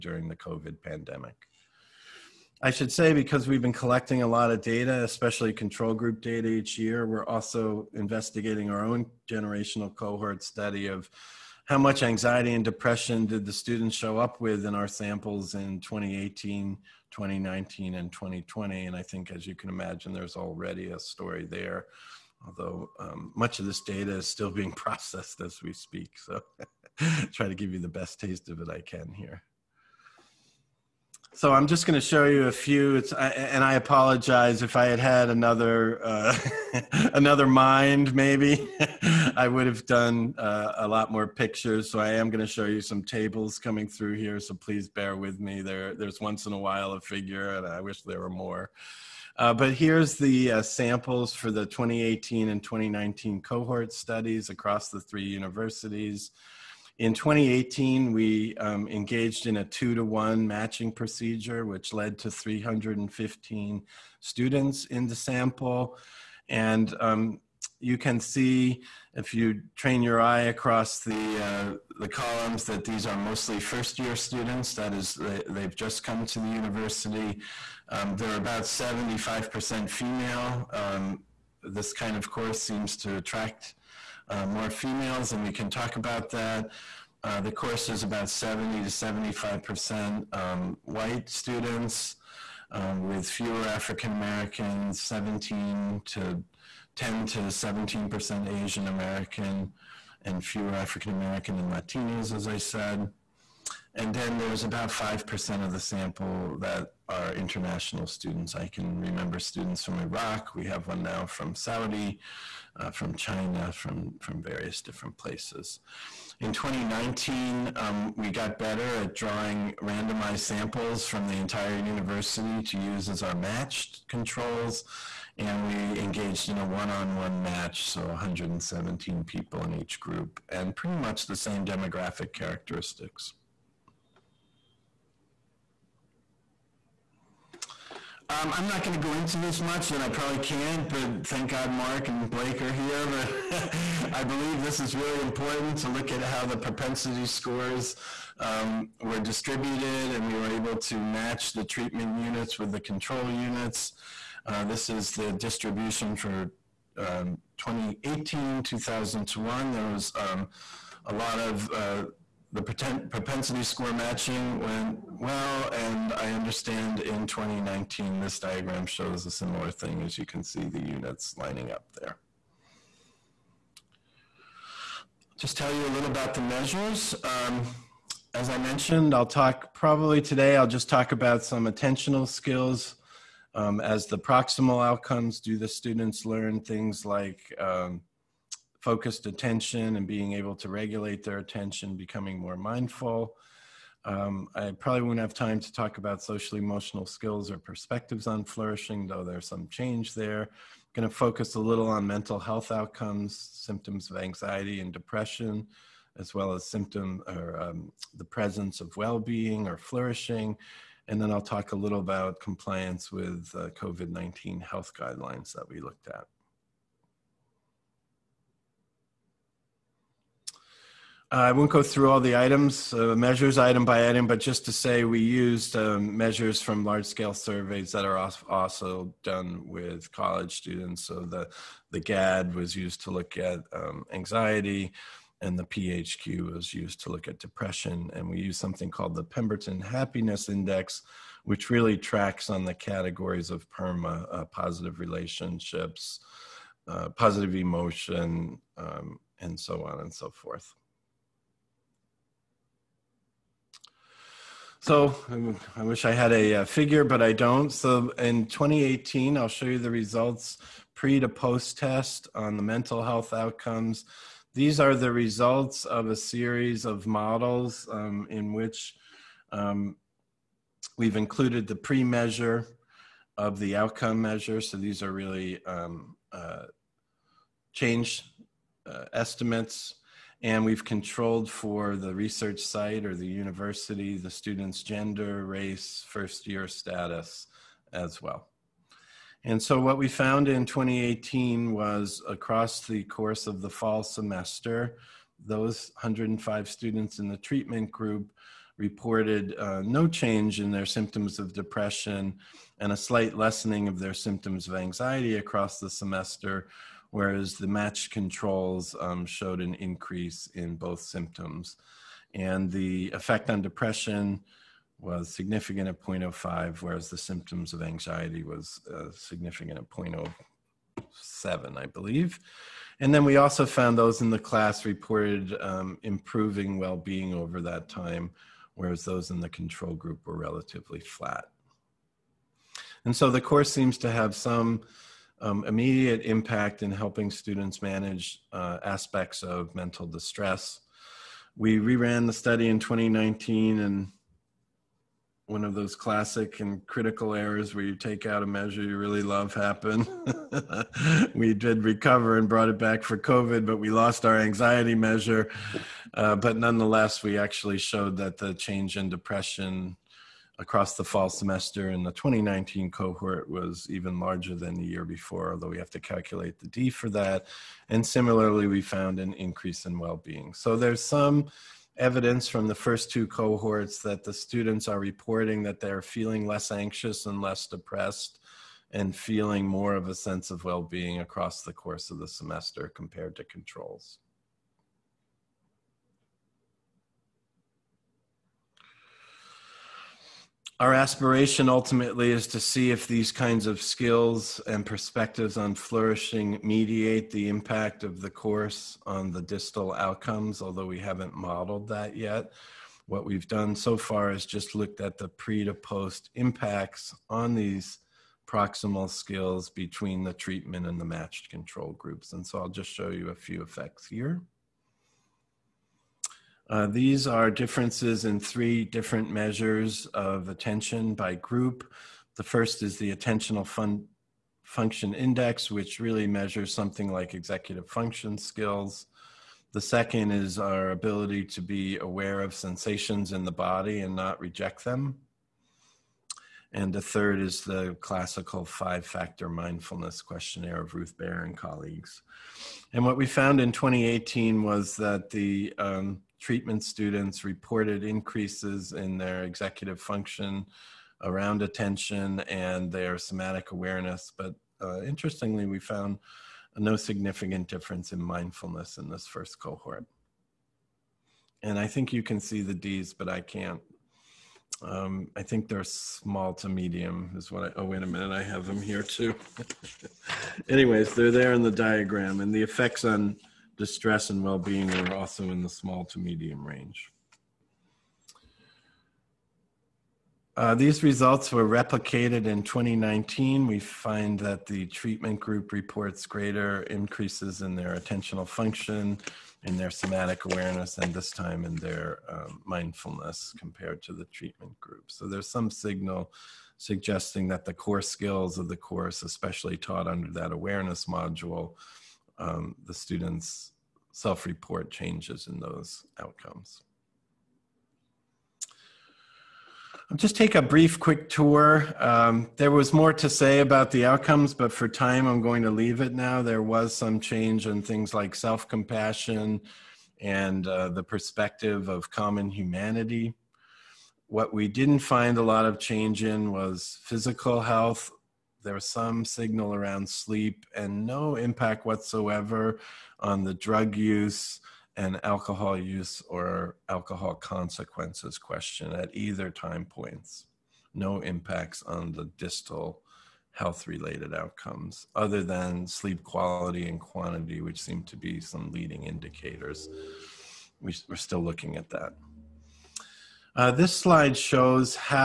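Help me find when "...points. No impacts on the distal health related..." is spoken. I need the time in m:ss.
8:59.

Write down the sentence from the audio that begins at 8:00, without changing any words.
Uh, these results were replicated in 2019.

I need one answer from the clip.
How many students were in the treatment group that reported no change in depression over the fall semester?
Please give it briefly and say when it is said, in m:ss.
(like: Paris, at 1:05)
105, at 4:55.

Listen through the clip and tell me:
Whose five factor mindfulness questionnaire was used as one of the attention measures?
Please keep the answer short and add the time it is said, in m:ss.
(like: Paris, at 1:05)
Ruth Baer, at 7:20.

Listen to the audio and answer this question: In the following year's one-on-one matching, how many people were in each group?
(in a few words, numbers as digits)
117.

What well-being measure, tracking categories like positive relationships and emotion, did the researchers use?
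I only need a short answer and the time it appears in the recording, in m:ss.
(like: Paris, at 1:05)
Pemberton Happiness Index, at 3:59.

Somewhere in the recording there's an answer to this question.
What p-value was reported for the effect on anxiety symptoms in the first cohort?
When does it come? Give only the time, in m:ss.
5:19.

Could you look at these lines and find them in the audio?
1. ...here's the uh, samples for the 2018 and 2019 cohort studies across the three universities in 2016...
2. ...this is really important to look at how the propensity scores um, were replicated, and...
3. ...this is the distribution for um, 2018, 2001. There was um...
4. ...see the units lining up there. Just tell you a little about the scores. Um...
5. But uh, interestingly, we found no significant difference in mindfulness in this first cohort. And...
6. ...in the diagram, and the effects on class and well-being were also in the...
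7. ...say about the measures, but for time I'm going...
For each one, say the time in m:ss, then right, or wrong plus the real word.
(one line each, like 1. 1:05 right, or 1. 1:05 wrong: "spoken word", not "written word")
1. 0:49 wrong: "2018", not "2016"
2. 2:24 wrong: "distributed", not "replicated"
3. 2:34 right
4. 2:50 wrong: "measures", not "scores"
5. 7:34 right
6. 7:51 wrong: "distress", not "class"
7. 8:33 wrong: "outcomes", not "measures".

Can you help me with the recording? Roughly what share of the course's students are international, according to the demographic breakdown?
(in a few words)
5%.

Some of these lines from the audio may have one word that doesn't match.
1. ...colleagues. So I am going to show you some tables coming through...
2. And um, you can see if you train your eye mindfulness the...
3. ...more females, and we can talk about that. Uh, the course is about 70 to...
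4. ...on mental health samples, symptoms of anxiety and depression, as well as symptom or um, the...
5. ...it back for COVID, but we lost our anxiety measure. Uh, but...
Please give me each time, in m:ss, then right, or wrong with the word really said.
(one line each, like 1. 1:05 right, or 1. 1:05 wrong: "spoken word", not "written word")
1. 0:41 wrong: "pictures", not "colleagues"
2. 1:06 wrong: "across", not "mindfulness"
3. 1:24 right
4. 3:21 wrong: "outcomes", not "samples"
5. 5:52 right.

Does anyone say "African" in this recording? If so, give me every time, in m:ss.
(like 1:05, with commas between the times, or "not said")
1:33, 1:40.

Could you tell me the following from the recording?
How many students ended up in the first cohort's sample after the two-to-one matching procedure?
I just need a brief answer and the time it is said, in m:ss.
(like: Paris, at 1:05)
315, at 1:02.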